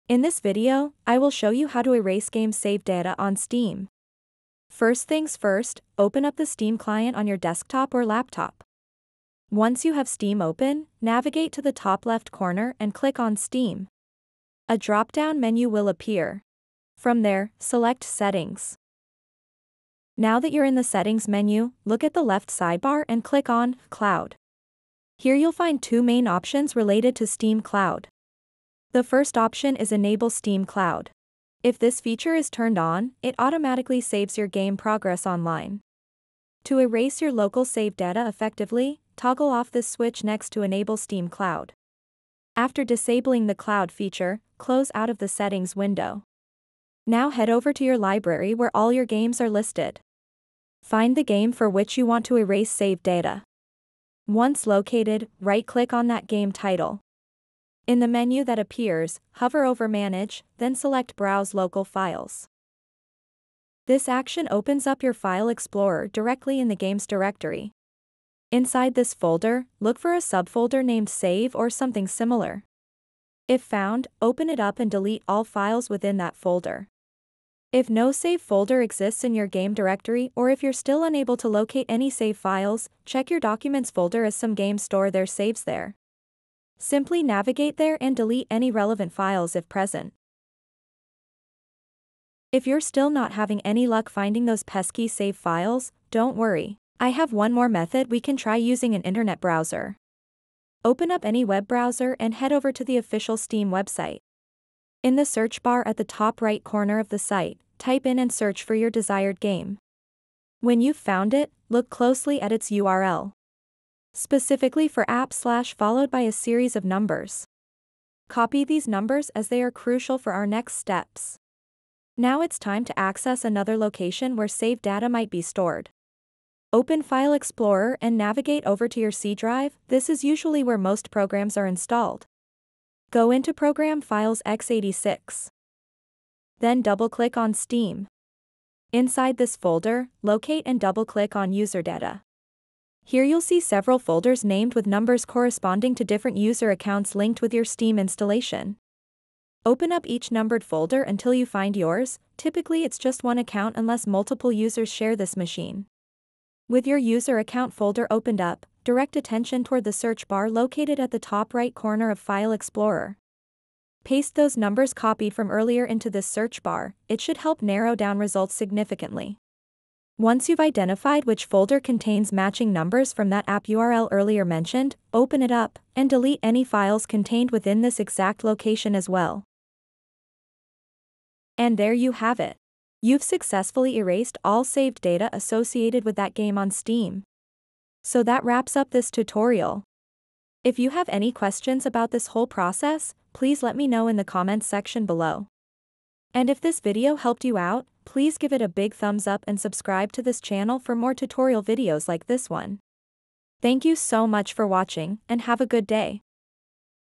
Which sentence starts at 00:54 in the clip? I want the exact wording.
Once located, right-click on that game title.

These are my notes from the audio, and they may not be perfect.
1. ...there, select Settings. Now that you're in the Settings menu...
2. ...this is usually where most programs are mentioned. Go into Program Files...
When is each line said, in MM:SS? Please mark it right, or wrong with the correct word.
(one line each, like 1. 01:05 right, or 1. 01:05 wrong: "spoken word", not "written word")
1. 00:17 right
2. 02:09 wrong: "installed", not "mentioned".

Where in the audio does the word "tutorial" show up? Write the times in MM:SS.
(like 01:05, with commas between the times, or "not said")
03:09, 03:21.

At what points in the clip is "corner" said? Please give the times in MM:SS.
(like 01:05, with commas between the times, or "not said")
00:12, 01:46, 02:41.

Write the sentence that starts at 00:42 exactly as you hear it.
After disabling the cloud feature, close out of the settings window.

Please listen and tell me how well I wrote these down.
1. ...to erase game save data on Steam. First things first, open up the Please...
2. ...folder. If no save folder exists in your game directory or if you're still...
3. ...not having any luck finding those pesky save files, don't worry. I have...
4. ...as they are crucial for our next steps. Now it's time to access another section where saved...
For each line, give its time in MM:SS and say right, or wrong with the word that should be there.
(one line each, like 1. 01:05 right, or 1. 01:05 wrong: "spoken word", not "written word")
1. 00:01 wrong: "Steam", not "Please"
2. 01:16 right
3. 01:33 right
4. 01:59 wrong: "location", not "section".